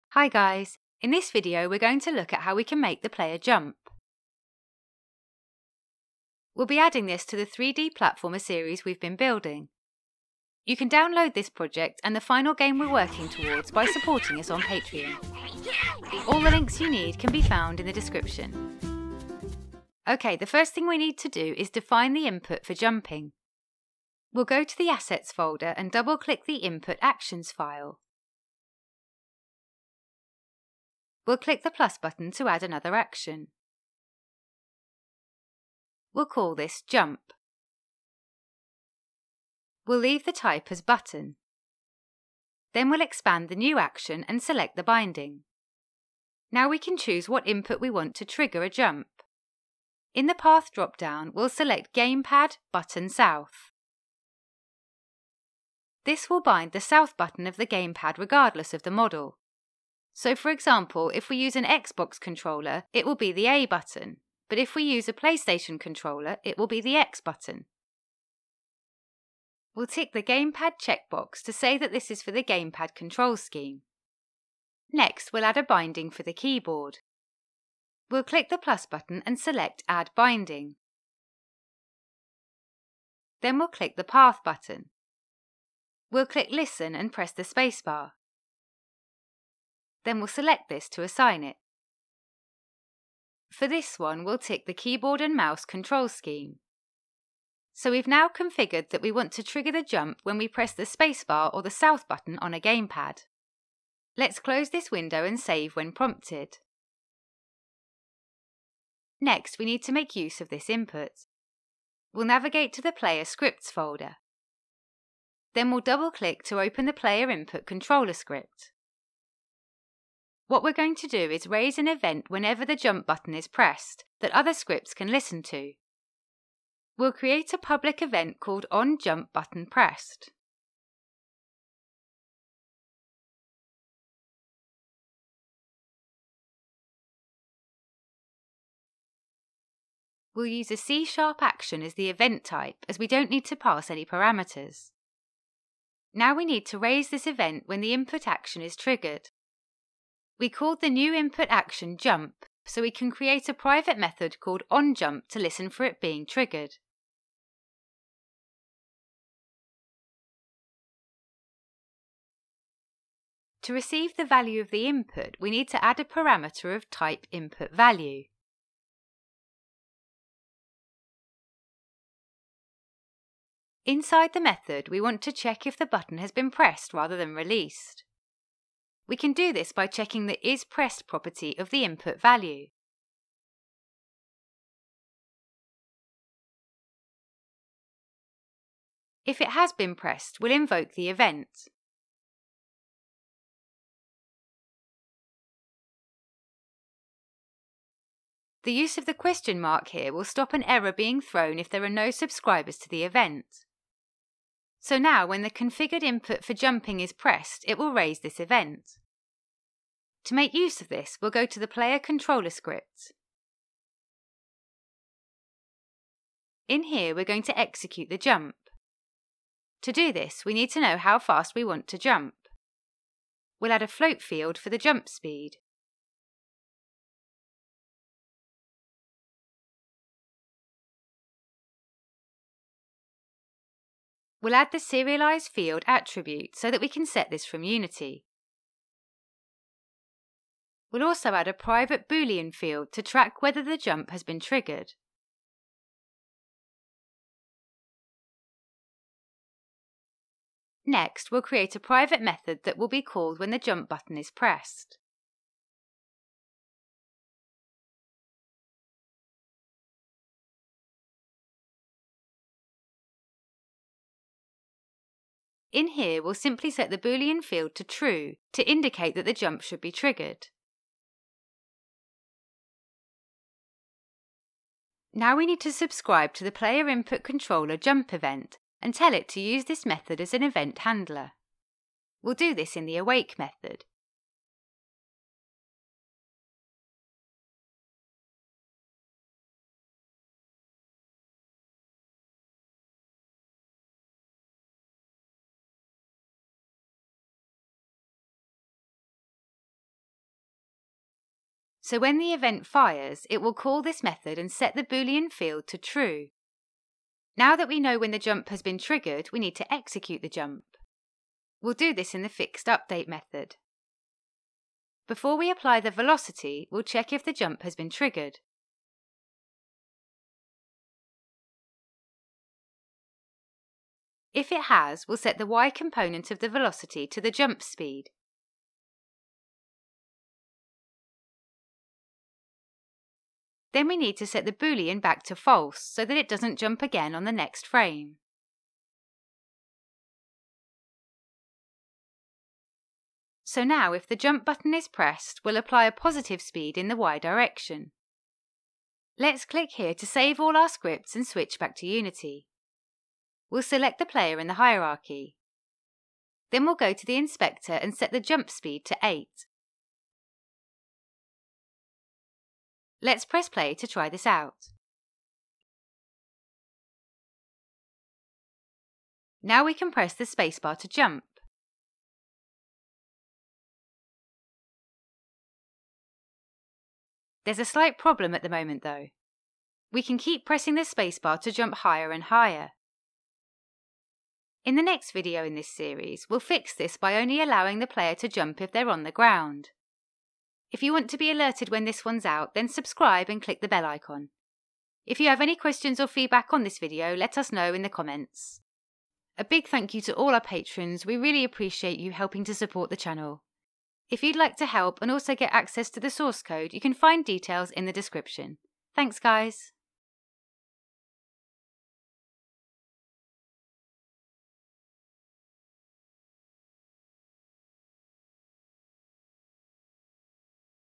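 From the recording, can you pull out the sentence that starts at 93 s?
For this one, we'll tick the keyboard and mouse control scheme.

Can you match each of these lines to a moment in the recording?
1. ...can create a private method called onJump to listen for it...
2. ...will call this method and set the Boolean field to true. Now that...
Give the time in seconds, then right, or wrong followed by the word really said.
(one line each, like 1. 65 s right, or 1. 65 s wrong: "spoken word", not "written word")
1. 152 s right
2. 303 s right.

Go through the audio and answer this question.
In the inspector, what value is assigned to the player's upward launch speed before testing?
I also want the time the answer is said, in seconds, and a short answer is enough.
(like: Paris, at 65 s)
8, at 359 s.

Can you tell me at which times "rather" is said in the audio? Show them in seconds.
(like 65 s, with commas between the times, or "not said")
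176 s.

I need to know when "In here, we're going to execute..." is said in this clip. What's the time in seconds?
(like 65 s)
216 s.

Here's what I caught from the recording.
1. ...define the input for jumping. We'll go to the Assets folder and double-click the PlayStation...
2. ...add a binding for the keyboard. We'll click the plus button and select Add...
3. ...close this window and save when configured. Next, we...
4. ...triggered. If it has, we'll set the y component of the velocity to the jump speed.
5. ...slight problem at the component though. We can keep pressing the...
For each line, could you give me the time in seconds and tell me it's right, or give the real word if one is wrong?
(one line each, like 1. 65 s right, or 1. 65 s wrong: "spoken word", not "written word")
1. 21 s wrong: "Input", not "PlayStation"
2. 75 s right
3. 104 s wrong: "prompted", not "configured"
4. 317 s right
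5. 377 s wrong: "moment", not "component".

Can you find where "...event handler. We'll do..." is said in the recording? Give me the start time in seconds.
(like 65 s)
280 s.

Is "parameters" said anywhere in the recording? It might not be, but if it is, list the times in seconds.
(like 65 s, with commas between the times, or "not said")
144 s, 166 s.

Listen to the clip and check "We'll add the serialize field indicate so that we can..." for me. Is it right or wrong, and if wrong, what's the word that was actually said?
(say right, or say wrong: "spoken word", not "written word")
wrong: "attribute", not "indicate".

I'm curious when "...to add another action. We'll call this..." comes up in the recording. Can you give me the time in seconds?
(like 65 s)
32 s.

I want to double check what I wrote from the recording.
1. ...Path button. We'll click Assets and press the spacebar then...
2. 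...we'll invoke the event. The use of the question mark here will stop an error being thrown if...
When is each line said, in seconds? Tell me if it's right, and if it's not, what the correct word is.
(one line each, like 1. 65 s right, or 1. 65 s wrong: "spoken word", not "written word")
1. 84 s wrong: "Listen", not "Assets"
2. 190 s right.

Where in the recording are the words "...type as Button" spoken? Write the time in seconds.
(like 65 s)
40 s.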